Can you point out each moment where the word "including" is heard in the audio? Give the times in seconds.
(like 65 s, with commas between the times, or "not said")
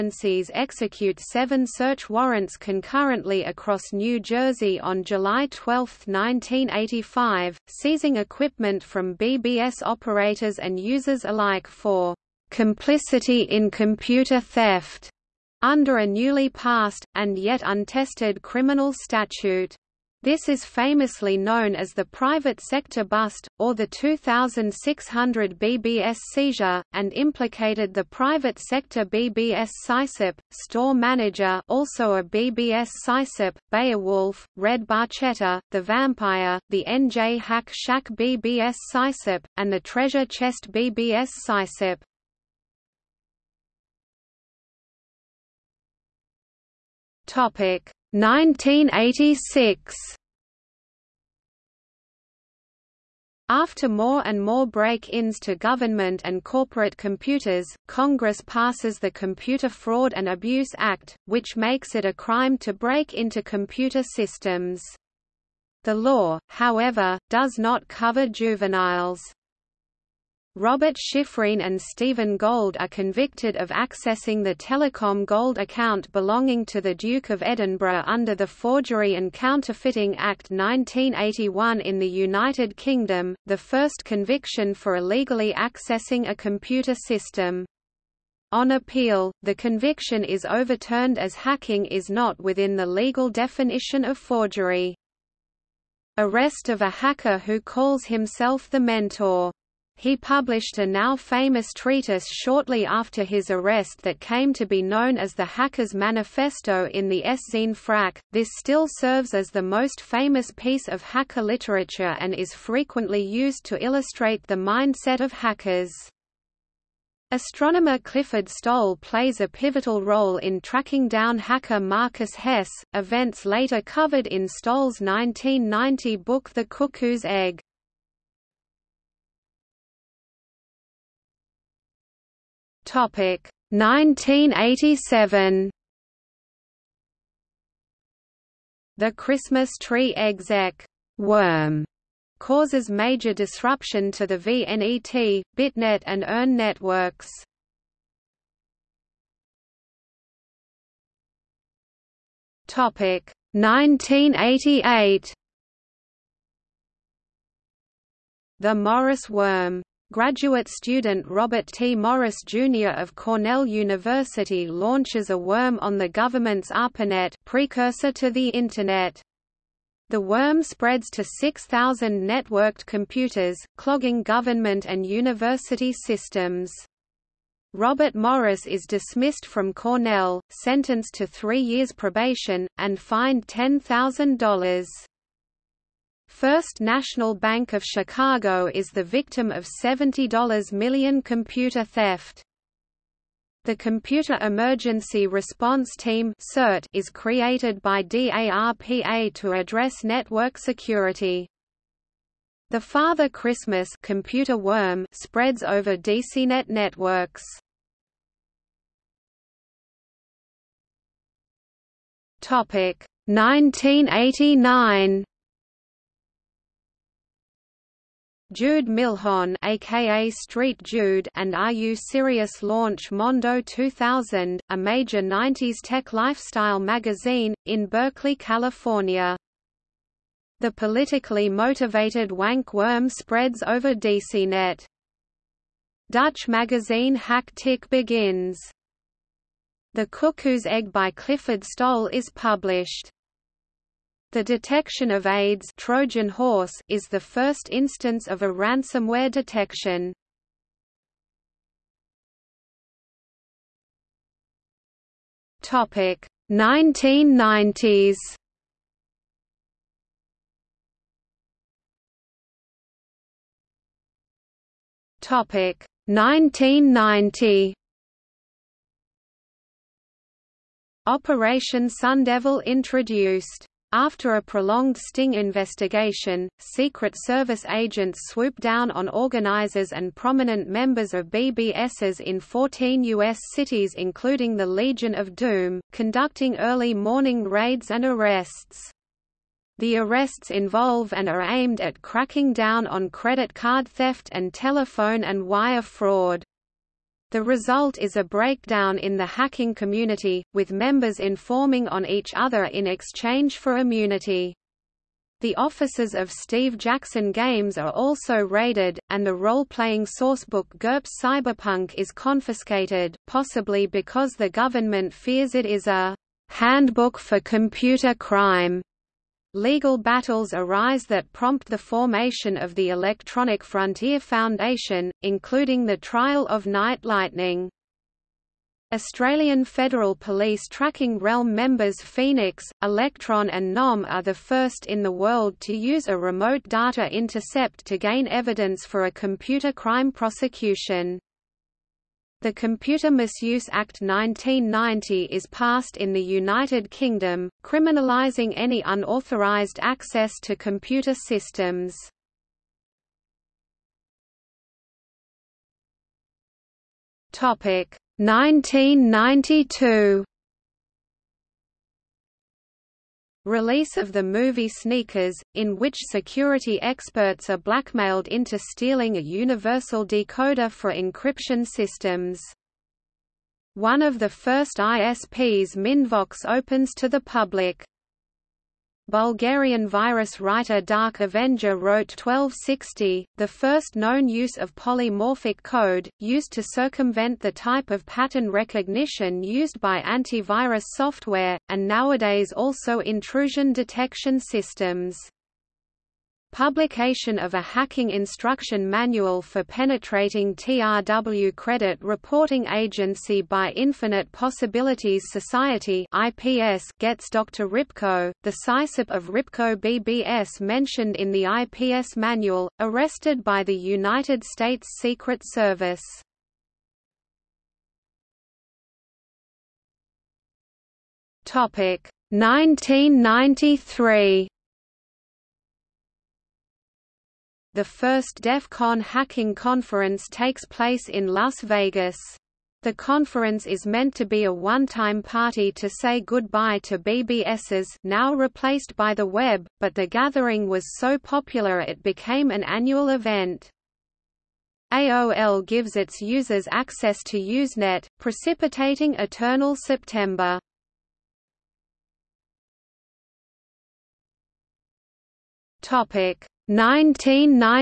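283 s, 325 s.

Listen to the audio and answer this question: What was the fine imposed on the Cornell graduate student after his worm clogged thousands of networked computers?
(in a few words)
$10,000.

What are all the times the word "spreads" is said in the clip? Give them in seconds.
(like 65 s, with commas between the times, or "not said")
170 s, 205 s, 233 s.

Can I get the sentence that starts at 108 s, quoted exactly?
This still serves as the most famous piece of hacker literature and is frequently used to illustrate the mindset of hackers.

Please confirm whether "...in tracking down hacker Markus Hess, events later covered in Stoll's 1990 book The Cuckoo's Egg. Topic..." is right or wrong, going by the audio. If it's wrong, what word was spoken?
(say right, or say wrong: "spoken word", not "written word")
right.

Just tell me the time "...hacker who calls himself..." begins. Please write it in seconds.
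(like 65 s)
96 s.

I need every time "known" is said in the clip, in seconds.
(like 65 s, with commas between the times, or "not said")
21 s, 104 s, 383 s.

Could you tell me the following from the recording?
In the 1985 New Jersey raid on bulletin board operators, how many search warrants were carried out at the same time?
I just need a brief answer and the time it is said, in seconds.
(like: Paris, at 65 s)
7, at 1 s.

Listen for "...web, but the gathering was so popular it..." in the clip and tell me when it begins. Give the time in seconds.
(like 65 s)
439 s.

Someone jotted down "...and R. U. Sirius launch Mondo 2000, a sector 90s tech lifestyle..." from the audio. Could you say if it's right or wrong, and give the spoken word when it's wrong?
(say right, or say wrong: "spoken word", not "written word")
wrong: "major", not "sector".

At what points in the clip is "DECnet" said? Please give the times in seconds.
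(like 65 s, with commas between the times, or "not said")
205 s, 233 s.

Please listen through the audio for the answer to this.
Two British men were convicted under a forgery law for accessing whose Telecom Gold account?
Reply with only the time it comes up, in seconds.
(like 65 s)
76 s.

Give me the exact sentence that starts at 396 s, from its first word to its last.
Publication of a hacking instruction manual for penetrating TRW Credit Reporting Agency by Infinite Possibilities Society IPS gets Dr.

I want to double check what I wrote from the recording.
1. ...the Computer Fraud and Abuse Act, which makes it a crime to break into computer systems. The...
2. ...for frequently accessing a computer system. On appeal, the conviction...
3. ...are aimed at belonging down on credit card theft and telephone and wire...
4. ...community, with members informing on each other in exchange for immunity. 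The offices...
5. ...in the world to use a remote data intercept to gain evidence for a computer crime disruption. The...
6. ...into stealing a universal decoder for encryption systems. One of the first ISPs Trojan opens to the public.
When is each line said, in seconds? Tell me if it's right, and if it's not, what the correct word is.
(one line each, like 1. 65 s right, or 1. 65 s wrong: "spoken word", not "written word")
1. 58 s right
2. 84 s wrong: "illegally", not "frequently"
3. 291 s wrong: "cracking", not "belonging"
4. 299 s right
5. 334 s wrong: "prosecution", not "disruption"
6. 368 s wrong: "MindVox", not "Trojan".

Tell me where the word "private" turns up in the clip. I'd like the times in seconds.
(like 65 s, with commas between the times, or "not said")
22 s, 28 s.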